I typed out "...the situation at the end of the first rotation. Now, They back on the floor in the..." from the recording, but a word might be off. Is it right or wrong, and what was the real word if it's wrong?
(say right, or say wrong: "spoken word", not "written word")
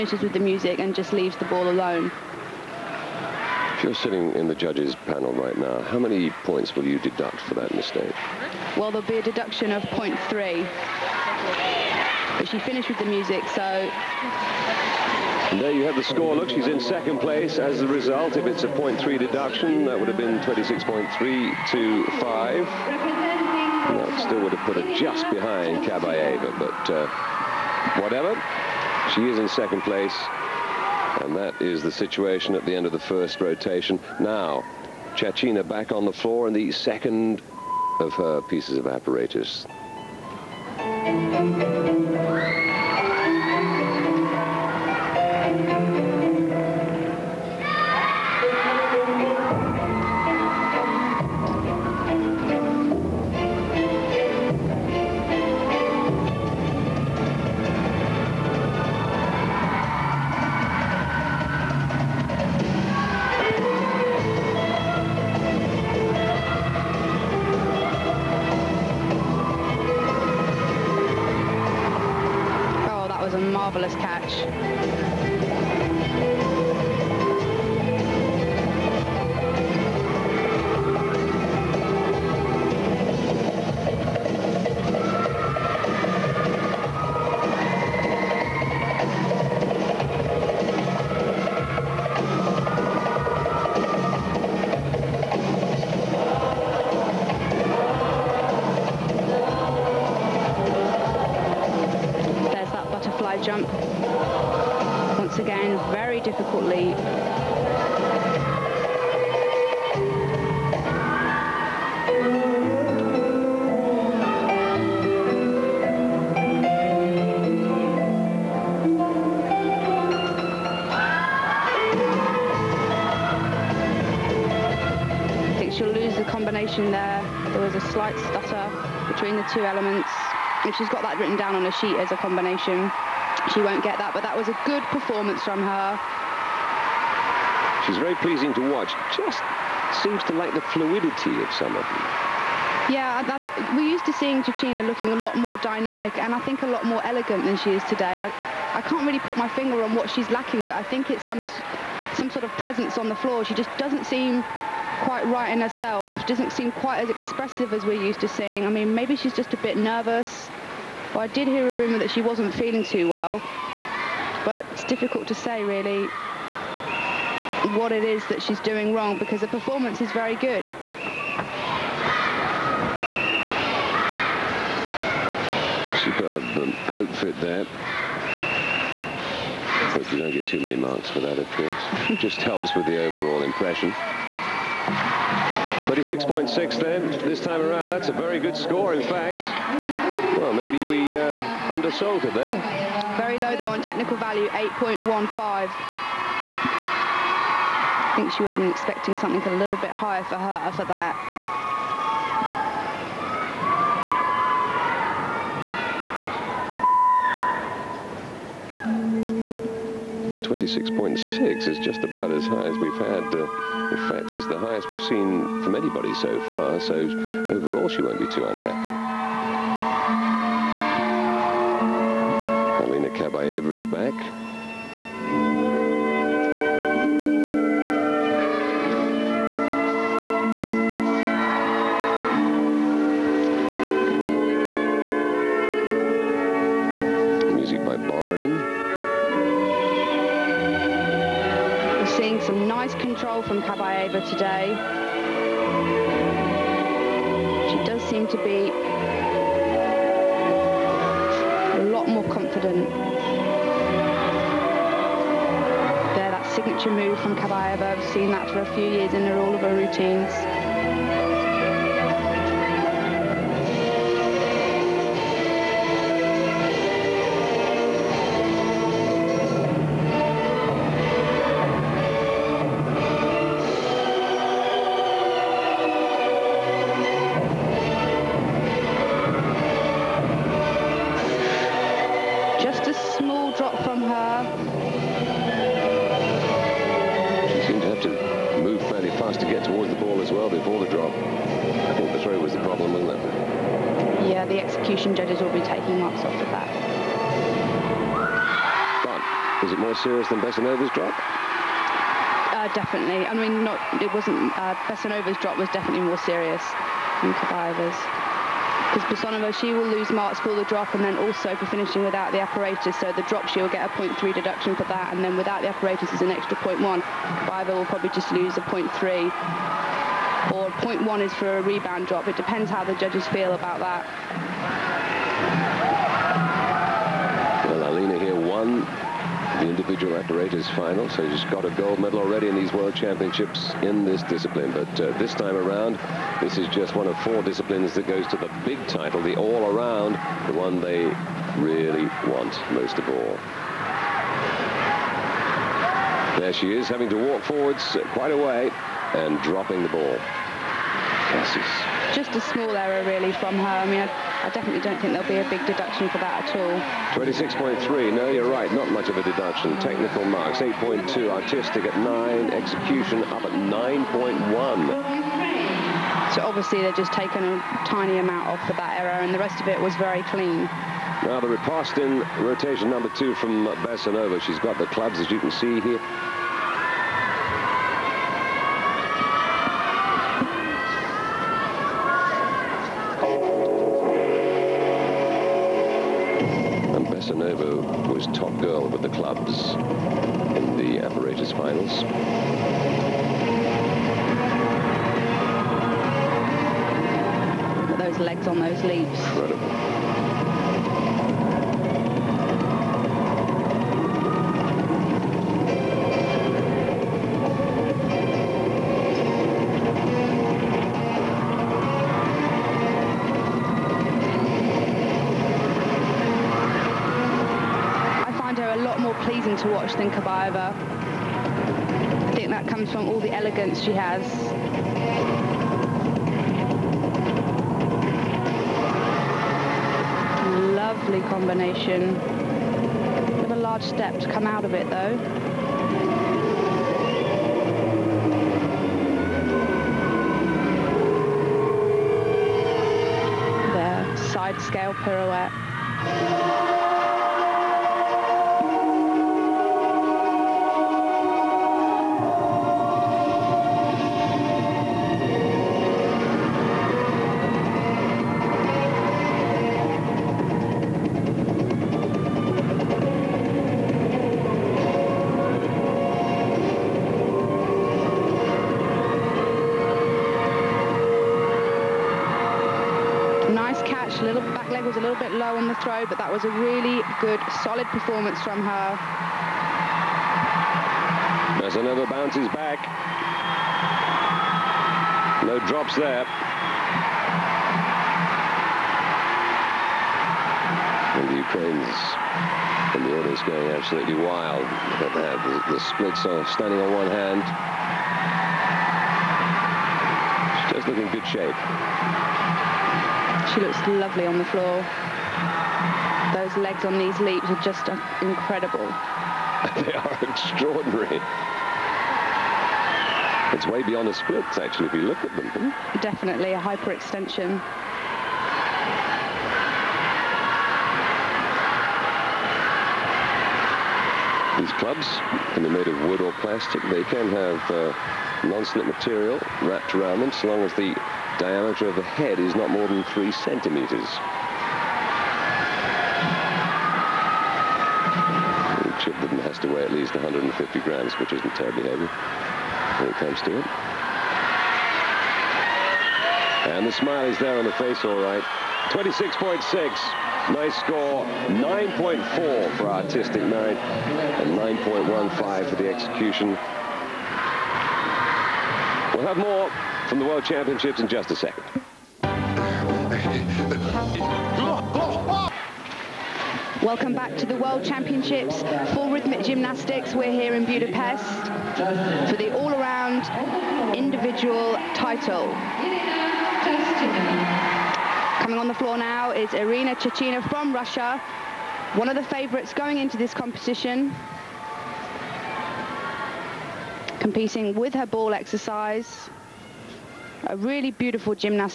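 wrong: "Tchachina", not "They".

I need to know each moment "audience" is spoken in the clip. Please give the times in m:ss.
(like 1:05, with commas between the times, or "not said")
8:13.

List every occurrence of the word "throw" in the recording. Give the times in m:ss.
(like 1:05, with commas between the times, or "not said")
4:52.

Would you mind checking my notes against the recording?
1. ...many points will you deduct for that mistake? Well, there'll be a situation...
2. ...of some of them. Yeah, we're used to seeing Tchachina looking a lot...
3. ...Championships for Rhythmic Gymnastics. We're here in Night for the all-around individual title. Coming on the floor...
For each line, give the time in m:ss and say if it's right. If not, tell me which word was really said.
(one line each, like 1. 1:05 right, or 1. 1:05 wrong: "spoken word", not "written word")
1. 0:05 wrong: "deduction", not "situation"
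2. 2:21 right
3. 9:27 wrong: "Budapest", not "Night".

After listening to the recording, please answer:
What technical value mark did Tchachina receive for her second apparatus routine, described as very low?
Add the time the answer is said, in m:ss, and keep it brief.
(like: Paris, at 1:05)
8.15, at 3:14.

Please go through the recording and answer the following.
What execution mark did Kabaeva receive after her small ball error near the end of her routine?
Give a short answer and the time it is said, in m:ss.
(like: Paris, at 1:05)
9.1, at 6:03.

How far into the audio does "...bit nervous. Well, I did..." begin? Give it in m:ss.
2:39.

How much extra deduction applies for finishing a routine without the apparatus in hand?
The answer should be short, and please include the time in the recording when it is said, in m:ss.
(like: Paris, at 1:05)
0.1, at 5:16.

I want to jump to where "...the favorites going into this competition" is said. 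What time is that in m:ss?
9:42.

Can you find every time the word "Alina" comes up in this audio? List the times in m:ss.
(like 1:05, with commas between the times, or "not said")
3:42, 5:27.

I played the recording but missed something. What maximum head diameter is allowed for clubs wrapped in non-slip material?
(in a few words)
3 centimeters.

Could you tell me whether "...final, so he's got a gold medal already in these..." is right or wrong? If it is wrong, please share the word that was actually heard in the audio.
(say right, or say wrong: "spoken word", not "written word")
right.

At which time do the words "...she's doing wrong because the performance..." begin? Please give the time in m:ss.
2:48.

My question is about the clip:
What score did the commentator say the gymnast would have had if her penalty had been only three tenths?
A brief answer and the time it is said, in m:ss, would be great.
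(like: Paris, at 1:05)
26.325, at 0:20.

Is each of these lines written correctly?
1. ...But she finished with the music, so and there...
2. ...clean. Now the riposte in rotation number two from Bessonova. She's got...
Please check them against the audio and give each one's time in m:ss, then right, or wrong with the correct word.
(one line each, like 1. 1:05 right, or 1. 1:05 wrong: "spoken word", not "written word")
1. 0:12 right
2. 6:10 right.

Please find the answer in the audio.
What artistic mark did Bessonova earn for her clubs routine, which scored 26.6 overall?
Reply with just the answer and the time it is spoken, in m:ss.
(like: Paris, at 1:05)
9.4, at 9:11.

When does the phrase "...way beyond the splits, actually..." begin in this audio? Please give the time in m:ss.
8:33.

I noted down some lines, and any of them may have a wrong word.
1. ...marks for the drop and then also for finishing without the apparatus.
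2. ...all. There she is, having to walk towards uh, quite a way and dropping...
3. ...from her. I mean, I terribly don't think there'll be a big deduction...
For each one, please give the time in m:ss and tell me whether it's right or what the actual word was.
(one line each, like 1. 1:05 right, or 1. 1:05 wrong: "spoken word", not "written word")
1. 5:10 right
2. 5:43 wrong: "forwards", not "towards"
3. 5:53 wrong: "definitely", not "terribly".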